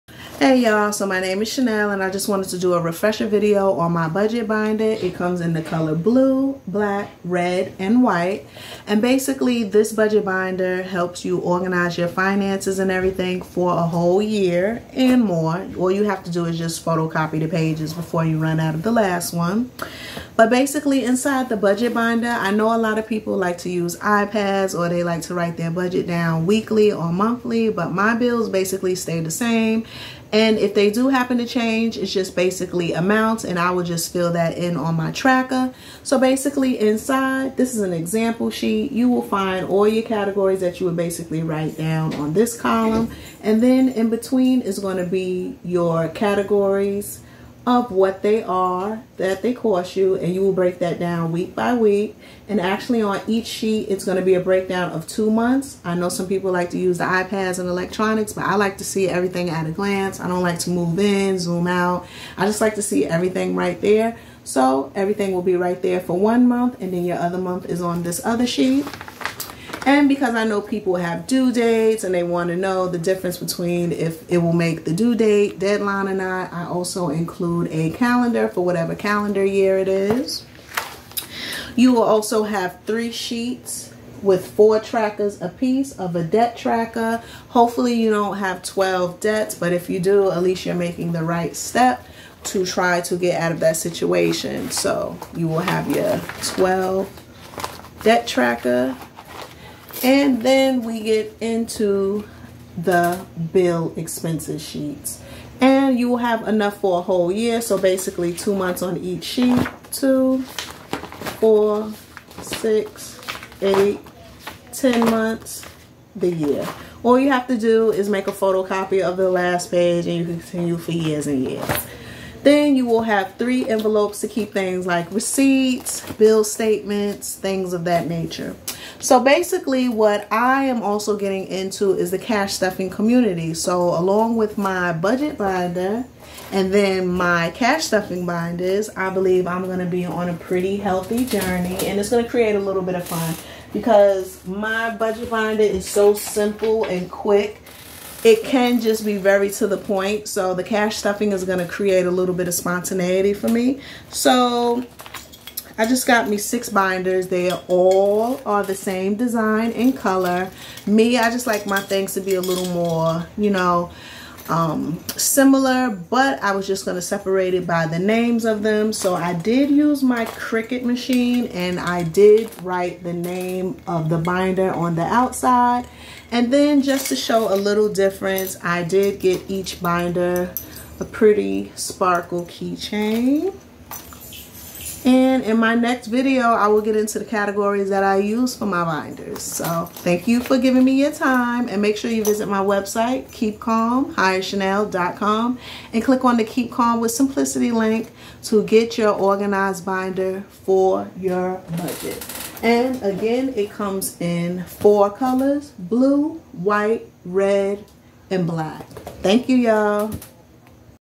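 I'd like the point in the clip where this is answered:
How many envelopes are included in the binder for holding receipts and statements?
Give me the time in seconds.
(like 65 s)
123 s.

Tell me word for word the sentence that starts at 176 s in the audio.
And then just to show a little difference, I did get each binder a pretty sparkle keychain.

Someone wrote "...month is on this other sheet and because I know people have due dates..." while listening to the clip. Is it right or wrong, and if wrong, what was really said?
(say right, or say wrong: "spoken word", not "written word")
right.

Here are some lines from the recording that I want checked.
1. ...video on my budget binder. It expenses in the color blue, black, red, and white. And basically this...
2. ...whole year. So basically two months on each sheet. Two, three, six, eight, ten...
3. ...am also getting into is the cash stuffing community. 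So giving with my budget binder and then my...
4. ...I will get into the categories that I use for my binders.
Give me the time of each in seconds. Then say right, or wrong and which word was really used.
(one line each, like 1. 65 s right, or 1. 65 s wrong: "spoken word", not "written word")
1. 3 s wrong: "comes", not "expenses"
2. 107 s wrong: "four", not "three"
3. 130 s wrong: "along", not "giving"
4. 186 s right.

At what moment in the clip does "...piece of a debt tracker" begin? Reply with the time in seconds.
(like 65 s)
85 s.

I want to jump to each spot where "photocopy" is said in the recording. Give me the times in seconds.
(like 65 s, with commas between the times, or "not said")
16 s, 118 s.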